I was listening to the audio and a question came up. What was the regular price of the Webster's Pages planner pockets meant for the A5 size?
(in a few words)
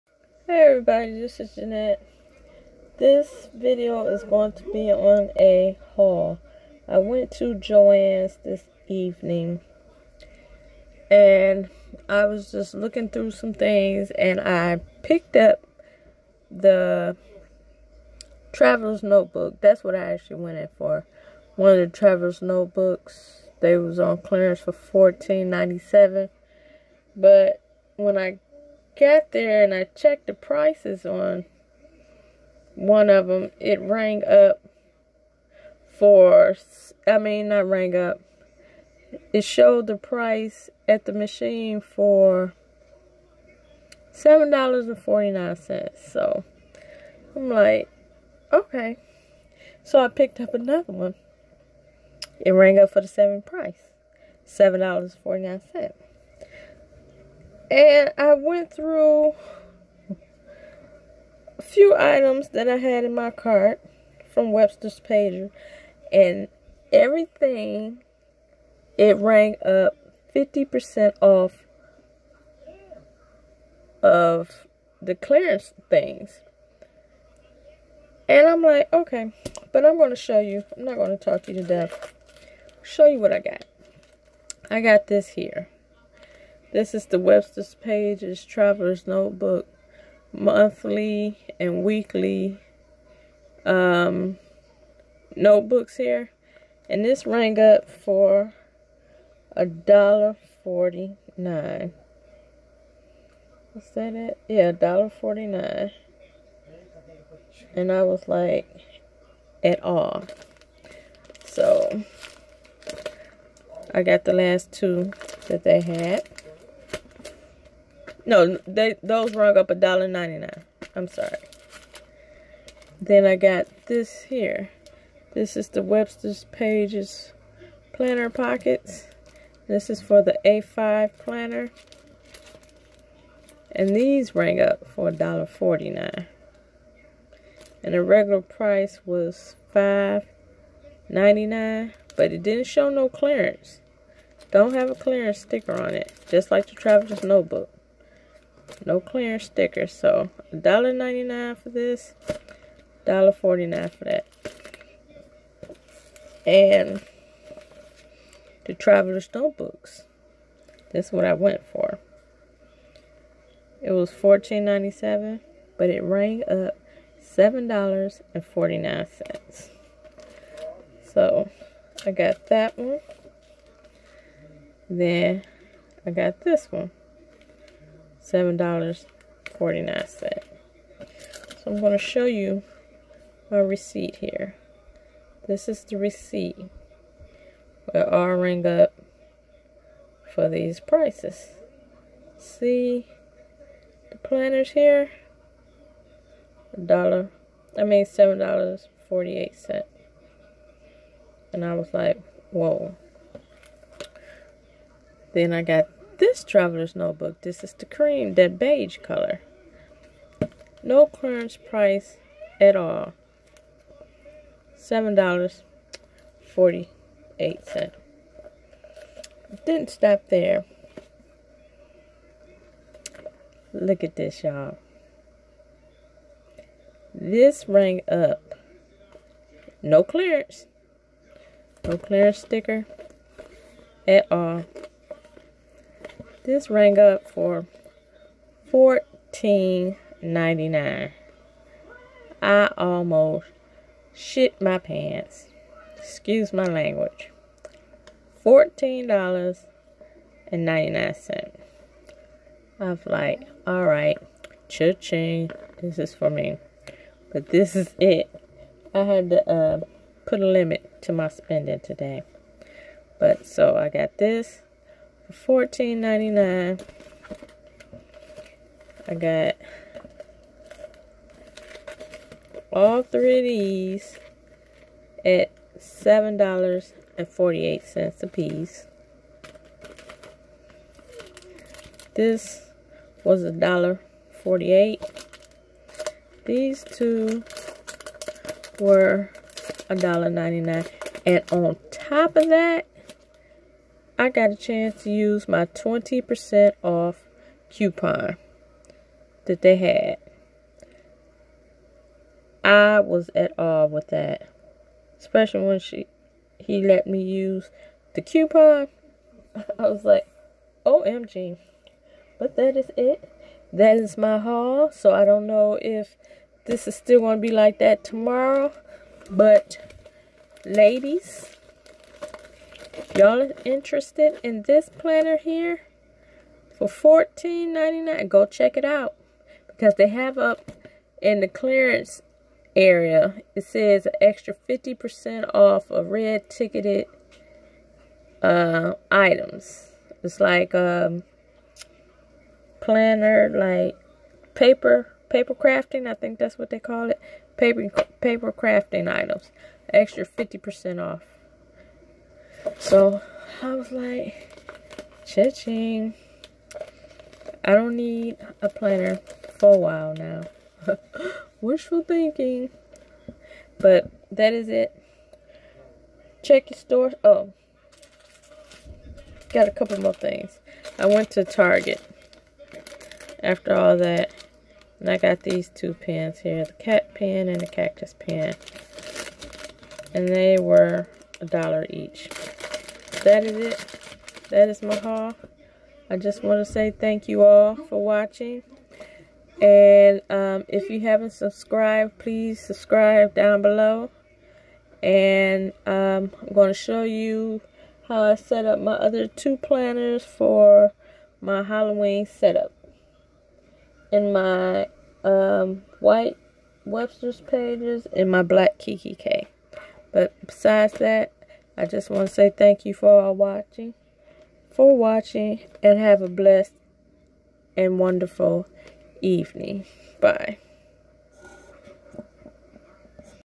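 $5.99.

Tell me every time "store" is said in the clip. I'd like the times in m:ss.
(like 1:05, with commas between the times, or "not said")
6:06.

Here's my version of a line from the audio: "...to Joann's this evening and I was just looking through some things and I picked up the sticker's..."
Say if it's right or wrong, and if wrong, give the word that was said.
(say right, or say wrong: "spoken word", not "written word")
wrong: "traveler", not "sticker".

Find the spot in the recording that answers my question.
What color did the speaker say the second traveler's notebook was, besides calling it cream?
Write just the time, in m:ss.
3:28.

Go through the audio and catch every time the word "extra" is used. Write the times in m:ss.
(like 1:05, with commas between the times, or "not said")
5:34, 5:49.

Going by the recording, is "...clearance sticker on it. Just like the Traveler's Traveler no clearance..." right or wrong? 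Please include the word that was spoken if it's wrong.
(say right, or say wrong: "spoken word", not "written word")
wrong: "Notebook", not "Traveler".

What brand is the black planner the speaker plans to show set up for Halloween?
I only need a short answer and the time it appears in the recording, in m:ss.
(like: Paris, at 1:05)
kikki.K, at 6:48.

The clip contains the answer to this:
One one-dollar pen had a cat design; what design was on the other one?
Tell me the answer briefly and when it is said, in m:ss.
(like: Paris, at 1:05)
cactus, at 6:17.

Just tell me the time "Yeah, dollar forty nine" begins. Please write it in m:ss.
1:44.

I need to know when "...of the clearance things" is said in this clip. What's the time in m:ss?
1:14.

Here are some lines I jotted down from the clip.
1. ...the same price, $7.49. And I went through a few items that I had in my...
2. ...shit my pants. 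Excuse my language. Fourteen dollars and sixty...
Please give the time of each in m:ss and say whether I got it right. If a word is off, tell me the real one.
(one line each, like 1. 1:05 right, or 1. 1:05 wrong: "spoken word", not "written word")
1. 0:53 right
2. 4:04 wrong: "ninety", not "sixty".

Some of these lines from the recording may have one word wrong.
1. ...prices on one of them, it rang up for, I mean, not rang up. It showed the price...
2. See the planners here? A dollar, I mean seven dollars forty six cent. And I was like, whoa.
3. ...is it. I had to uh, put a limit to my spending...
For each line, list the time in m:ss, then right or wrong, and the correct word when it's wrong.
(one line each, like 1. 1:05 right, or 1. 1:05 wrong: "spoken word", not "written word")
1. 0:30 right
2. 3:12 wrong: "eight", not "six"
3. 4:17 right.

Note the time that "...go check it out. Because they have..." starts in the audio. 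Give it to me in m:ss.
5:28.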